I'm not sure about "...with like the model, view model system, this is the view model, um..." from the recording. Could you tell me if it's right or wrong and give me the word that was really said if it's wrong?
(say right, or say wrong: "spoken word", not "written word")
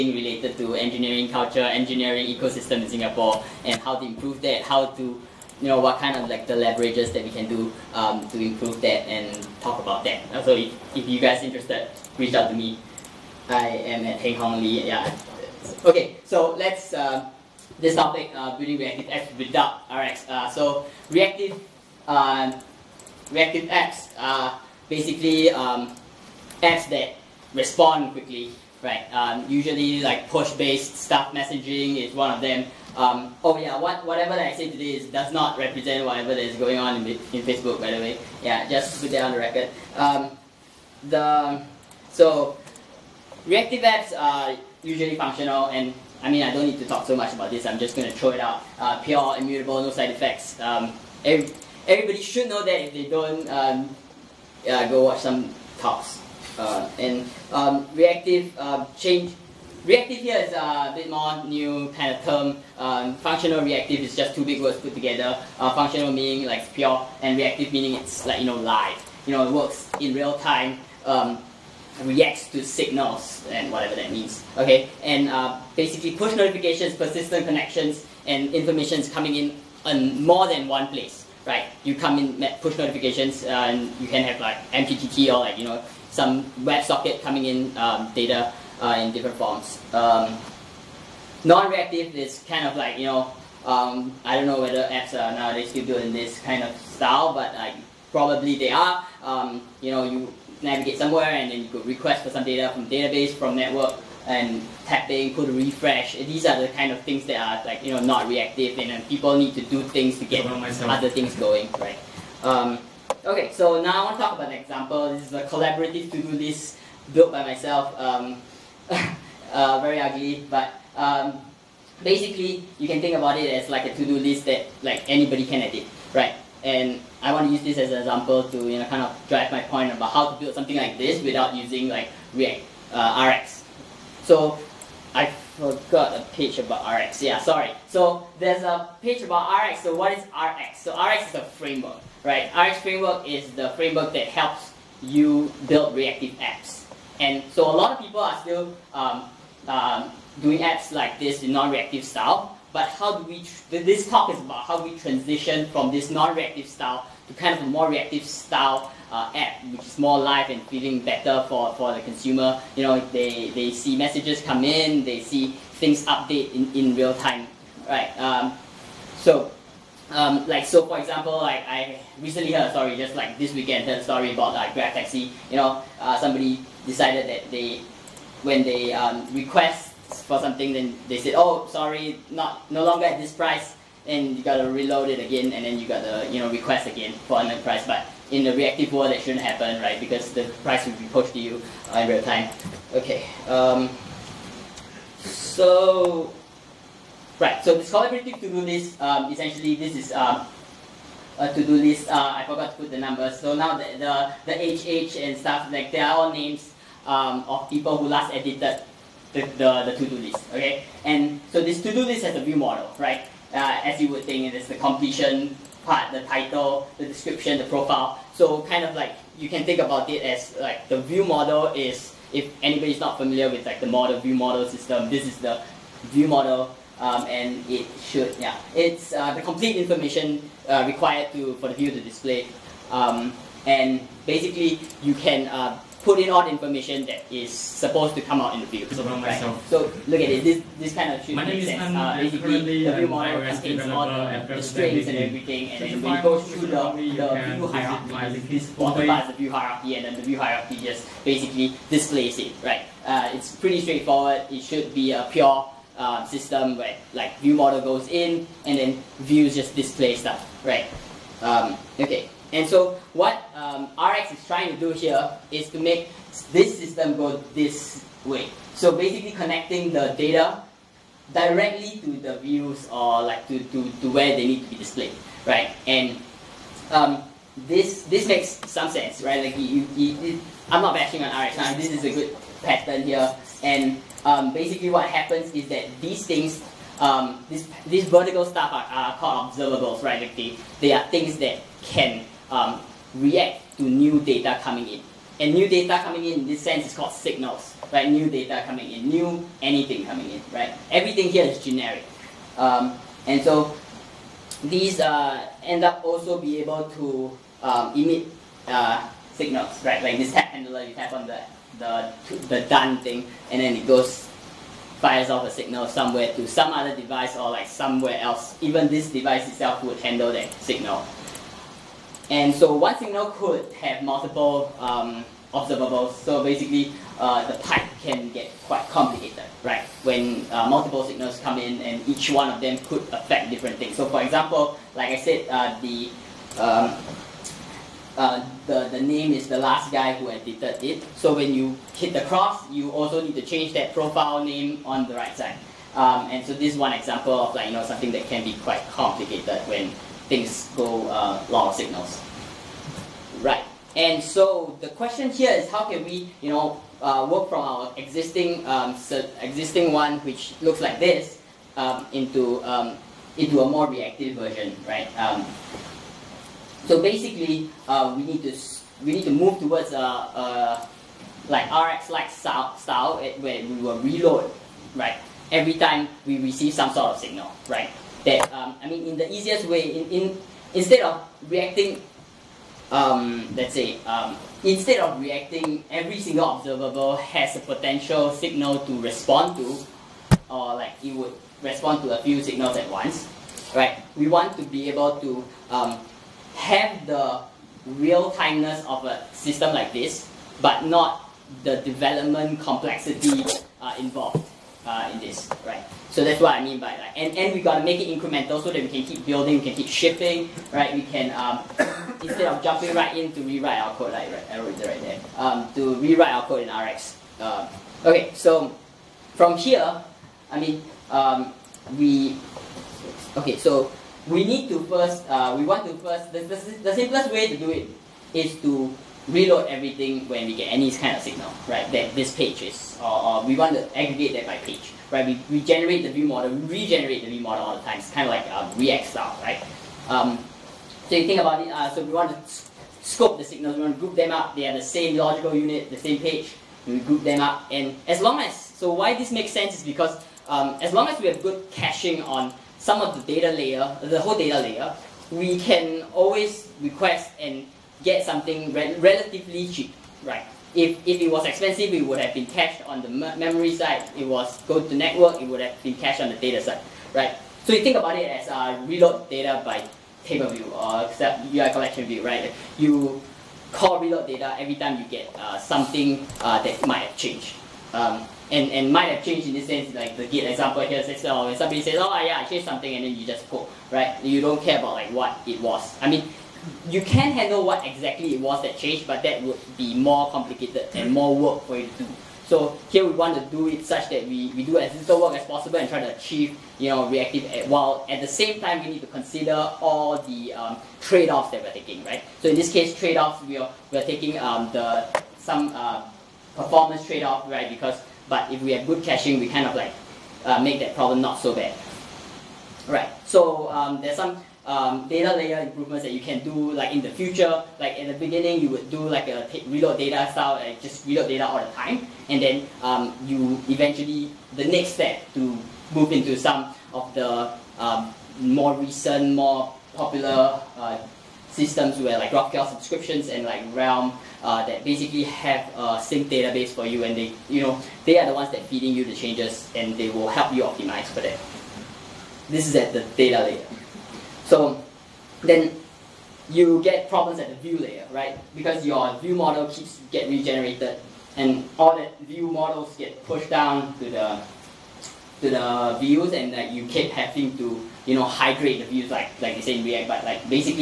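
right.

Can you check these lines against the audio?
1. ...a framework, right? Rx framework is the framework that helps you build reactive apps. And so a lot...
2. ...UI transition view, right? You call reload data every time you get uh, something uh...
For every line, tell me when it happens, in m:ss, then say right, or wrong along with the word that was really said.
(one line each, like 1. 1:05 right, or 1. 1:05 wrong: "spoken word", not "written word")
1. 2:21 right
2. 7:51 wrong: "collection", not "transition".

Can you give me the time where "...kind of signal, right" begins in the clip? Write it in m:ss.
7:10.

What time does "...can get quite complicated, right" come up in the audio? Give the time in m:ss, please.
5:28.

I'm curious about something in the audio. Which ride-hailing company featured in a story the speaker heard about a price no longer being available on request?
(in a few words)
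Grab Taxi.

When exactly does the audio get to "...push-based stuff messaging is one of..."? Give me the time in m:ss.
0:30.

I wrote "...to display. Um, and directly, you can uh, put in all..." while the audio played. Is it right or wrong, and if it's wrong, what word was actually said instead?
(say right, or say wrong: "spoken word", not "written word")
wrong: "basically", not "directly".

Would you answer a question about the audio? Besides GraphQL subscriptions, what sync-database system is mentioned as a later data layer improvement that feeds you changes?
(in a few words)
Realm.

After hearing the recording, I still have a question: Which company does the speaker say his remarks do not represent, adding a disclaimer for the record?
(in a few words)
Facebook.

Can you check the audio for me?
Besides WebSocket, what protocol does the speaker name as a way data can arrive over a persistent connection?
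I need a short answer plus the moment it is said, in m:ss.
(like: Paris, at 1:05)
MQTT, at 1:24.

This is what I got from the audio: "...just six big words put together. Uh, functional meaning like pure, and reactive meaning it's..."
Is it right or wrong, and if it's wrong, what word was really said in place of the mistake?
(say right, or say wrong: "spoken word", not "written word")
wrong: "two", not "six".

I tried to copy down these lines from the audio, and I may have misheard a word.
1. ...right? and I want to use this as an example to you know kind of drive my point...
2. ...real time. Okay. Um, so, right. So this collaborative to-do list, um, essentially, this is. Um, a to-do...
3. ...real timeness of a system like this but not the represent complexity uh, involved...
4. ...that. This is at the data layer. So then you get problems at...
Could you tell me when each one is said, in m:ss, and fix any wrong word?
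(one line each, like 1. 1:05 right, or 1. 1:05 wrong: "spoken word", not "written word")
1. 2:06 right
2. 3:12 right
3. 6:37 wrong: "development", not "represent"
4. 9:01 right.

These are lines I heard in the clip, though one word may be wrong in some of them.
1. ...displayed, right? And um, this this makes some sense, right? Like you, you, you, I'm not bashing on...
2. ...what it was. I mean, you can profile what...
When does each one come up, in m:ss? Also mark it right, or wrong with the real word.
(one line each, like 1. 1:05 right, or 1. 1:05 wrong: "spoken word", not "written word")
1. 4:34 right
2. 8:05 wrong: "handle", not "profile".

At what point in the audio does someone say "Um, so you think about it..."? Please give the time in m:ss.
7:20.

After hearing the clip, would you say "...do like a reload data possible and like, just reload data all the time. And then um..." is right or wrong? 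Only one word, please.
wrong.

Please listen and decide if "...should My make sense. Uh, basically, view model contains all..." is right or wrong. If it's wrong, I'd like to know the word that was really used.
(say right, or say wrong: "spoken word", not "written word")
right.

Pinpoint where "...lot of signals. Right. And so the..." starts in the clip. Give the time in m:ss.
5:51.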